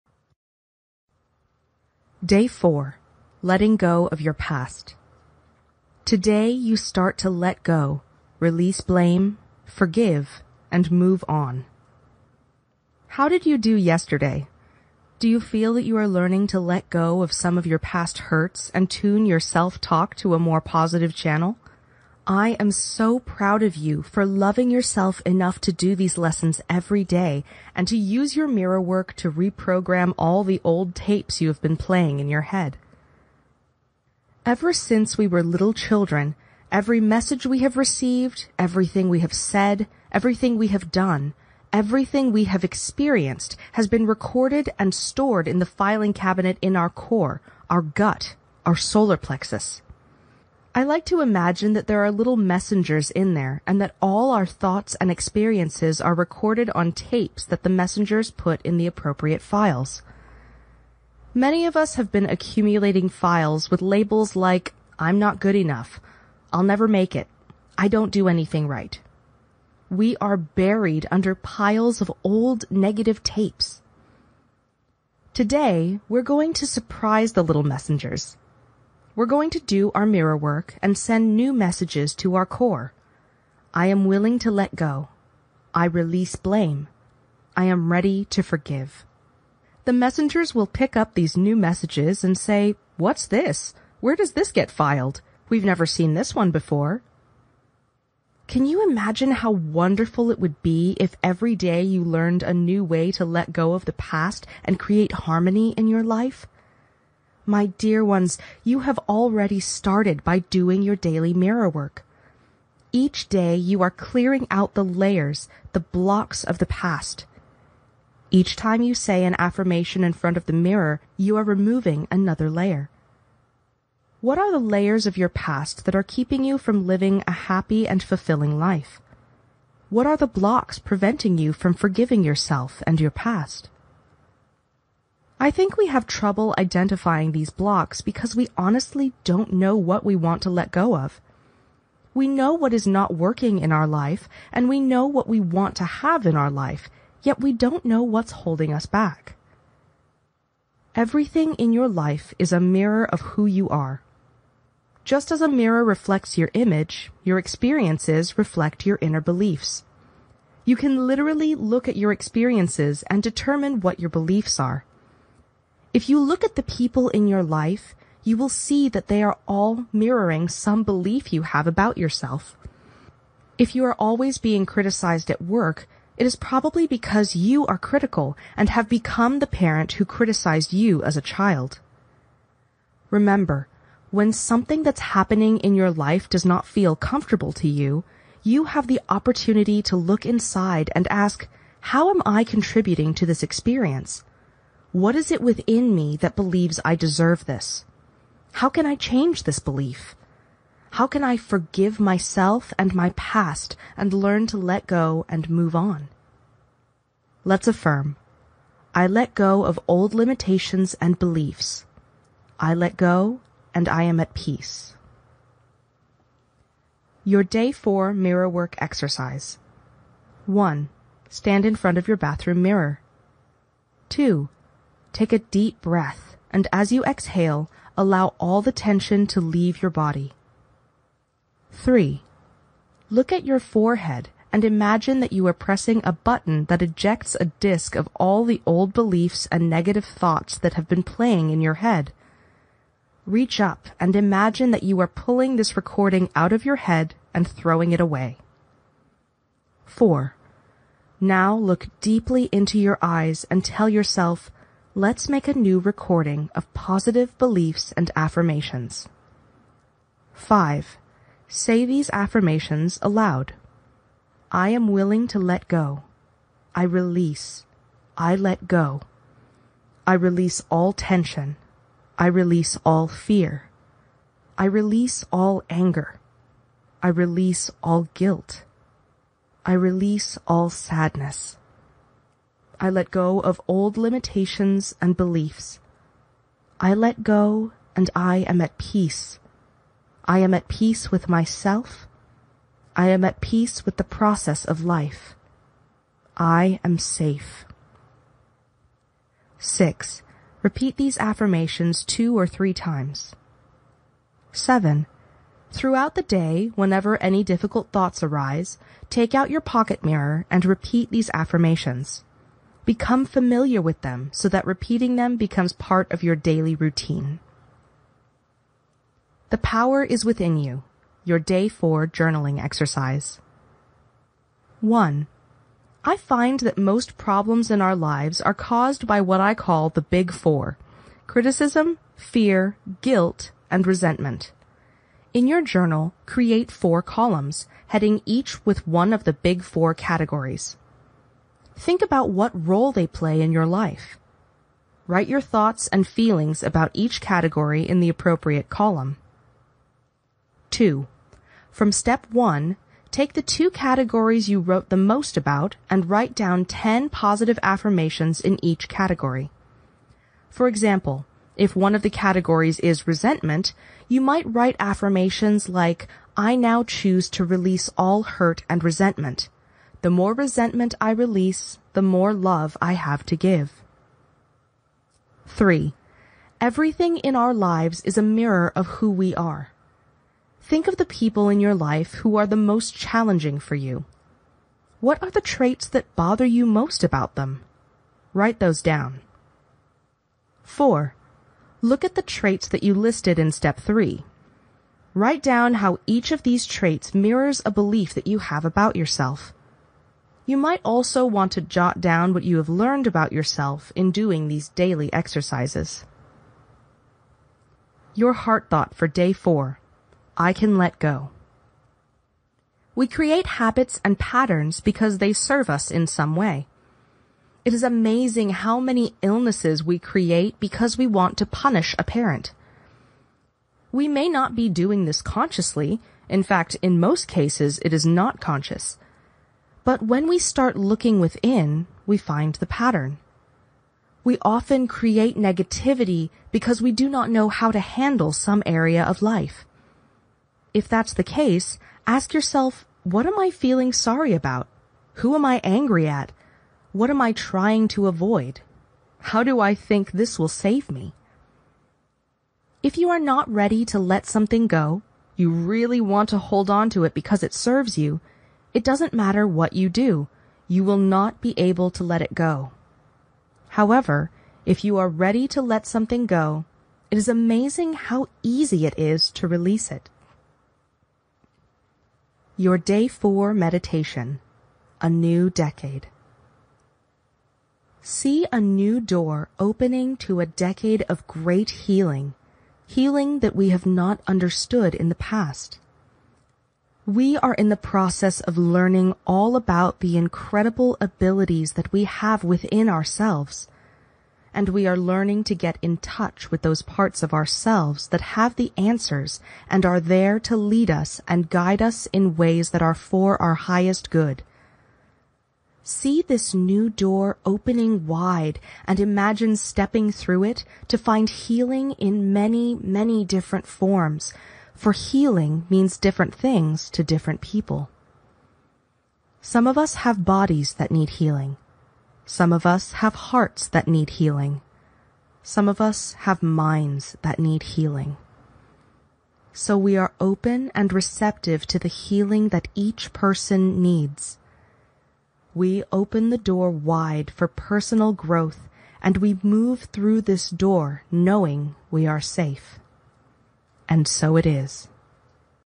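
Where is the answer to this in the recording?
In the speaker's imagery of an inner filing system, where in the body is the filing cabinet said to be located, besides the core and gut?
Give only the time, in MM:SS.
00:48.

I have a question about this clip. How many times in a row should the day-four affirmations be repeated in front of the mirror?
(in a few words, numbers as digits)
2 or 3 times.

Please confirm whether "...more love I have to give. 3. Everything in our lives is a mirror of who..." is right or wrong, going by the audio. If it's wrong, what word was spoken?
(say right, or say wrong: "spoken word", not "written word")
right.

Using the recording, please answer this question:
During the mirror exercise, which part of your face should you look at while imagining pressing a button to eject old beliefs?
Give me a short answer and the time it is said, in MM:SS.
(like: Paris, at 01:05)
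Forehead, at 03:53.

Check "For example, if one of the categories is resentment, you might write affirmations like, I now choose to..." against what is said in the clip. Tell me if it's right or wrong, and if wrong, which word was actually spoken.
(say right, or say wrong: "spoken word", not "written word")
right.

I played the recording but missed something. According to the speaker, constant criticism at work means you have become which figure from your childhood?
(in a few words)
The parent.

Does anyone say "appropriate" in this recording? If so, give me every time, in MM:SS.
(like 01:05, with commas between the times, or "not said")
00:58, 05:48.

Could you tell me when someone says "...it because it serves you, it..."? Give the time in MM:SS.
07:37.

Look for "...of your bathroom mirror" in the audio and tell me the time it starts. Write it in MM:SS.
03:41.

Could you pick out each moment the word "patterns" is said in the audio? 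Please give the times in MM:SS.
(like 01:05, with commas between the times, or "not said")
06:54, 07:12.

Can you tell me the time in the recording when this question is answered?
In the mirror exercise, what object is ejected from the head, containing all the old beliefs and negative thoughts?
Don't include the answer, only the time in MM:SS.
03:57.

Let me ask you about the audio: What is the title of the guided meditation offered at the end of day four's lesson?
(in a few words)
A New Decade.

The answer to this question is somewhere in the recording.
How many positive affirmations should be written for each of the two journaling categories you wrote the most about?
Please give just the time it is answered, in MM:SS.
05:56.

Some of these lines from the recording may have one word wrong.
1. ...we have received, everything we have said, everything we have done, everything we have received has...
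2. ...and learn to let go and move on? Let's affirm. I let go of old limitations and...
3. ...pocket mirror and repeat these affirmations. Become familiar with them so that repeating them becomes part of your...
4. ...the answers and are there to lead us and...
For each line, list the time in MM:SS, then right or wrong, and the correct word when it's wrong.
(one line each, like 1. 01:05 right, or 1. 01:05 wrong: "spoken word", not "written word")
1. 00:37 wrong: "experienced", not "received"
2. 03:23 right
3. 05:09 right
4. 08:18 right.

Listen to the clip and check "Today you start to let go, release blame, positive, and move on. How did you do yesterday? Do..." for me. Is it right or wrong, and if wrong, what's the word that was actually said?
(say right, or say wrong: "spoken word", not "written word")
wrong: "forgive", not "positive".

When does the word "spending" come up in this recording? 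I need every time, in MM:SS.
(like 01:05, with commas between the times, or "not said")
not said.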